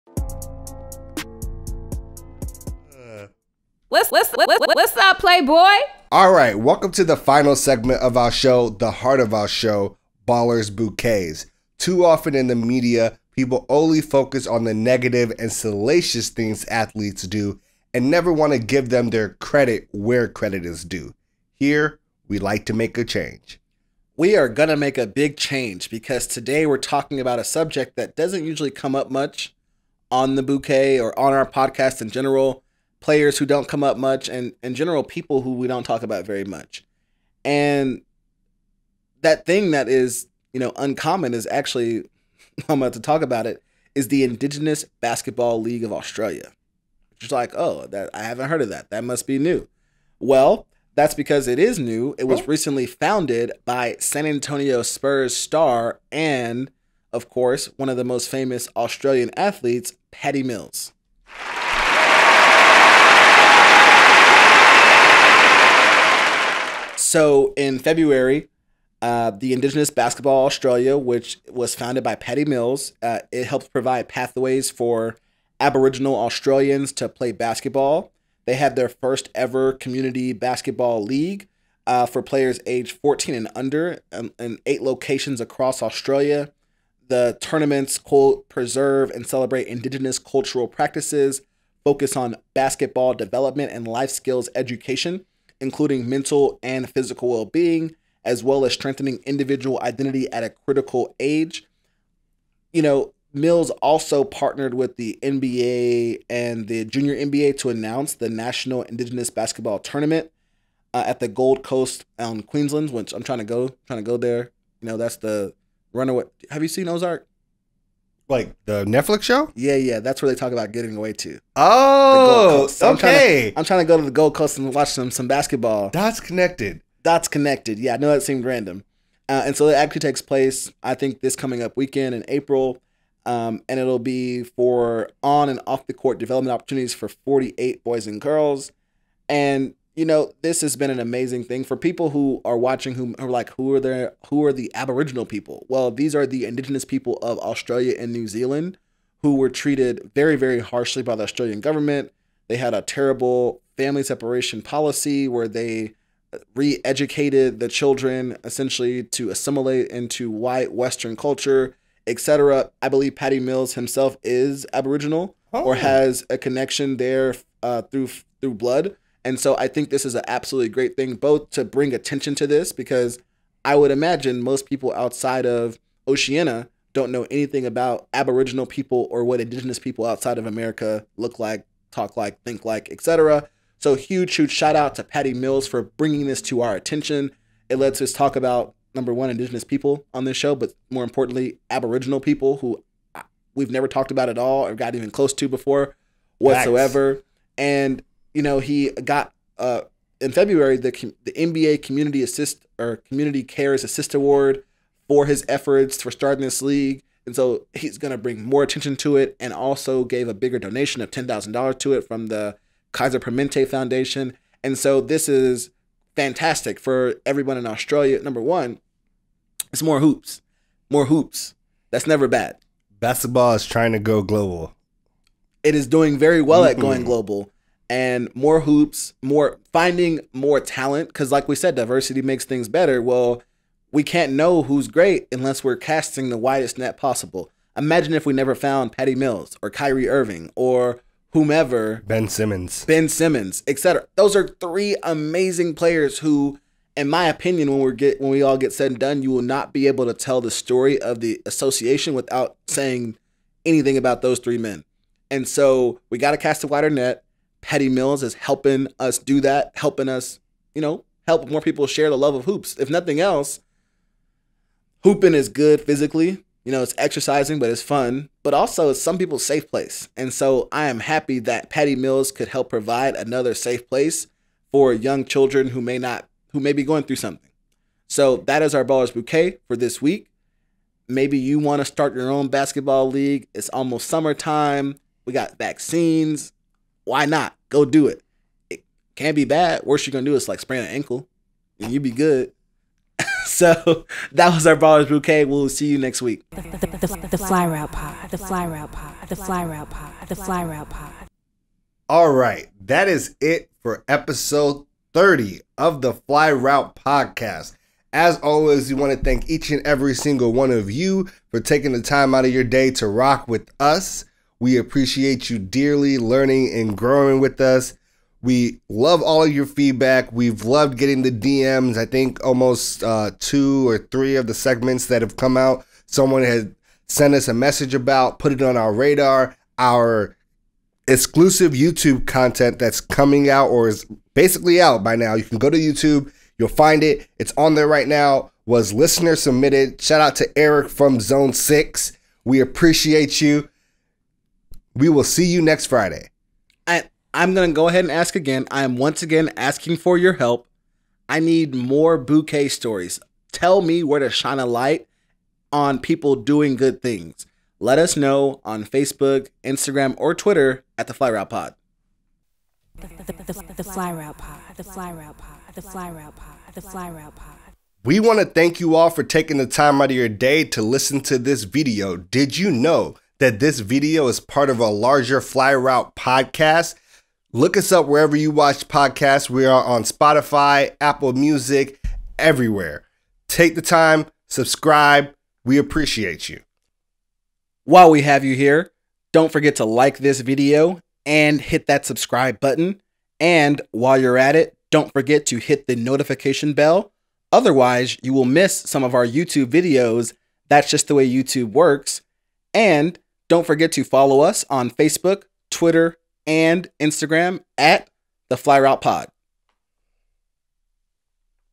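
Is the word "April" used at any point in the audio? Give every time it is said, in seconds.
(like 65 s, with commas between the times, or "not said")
132 s.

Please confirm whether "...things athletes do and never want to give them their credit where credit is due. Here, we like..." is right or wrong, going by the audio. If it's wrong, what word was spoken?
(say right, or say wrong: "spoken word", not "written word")
right.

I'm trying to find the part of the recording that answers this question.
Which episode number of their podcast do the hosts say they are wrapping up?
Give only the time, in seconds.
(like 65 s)
304 s.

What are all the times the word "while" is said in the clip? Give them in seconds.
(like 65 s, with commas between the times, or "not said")
387 s, 393 s.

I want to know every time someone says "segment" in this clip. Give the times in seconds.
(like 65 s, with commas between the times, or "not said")
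7 s, 324 s.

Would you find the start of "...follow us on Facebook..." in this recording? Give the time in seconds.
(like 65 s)
404 s.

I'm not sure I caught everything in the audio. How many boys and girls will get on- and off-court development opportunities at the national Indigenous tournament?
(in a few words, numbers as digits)
48.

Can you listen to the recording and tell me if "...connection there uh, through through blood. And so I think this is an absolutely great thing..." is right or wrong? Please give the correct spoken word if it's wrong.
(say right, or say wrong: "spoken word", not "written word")
right.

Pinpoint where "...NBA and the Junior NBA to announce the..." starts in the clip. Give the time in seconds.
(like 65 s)
105 s.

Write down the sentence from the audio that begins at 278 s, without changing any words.
So that is our Ballers Bouquet for this week.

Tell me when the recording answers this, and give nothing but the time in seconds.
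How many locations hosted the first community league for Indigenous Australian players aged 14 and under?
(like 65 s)
84 s.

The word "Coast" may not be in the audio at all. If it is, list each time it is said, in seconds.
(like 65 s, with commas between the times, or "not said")
111 s, 124 s.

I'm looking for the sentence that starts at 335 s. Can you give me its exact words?
You can go to YouTube, you'll find it.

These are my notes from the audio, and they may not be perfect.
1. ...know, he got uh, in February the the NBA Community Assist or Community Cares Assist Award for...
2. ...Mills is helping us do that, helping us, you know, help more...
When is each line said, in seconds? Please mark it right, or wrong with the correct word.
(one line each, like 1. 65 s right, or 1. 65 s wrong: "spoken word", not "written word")
1. 198 s right
2. 257 s right.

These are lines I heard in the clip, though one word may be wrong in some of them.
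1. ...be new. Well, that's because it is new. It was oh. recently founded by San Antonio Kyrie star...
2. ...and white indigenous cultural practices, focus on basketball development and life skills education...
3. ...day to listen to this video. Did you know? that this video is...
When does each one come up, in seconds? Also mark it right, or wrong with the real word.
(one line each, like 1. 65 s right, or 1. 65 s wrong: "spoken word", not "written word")
1. 49 s wrong: "Spurs", not "Kyrie"
2. 89 s wrong: "celebrate", not "white"
3. 370 s right.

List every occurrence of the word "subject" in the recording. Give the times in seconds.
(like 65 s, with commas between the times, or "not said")
27 s.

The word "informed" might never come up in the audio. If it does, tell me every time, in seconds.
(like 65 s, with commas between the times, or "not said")
not said.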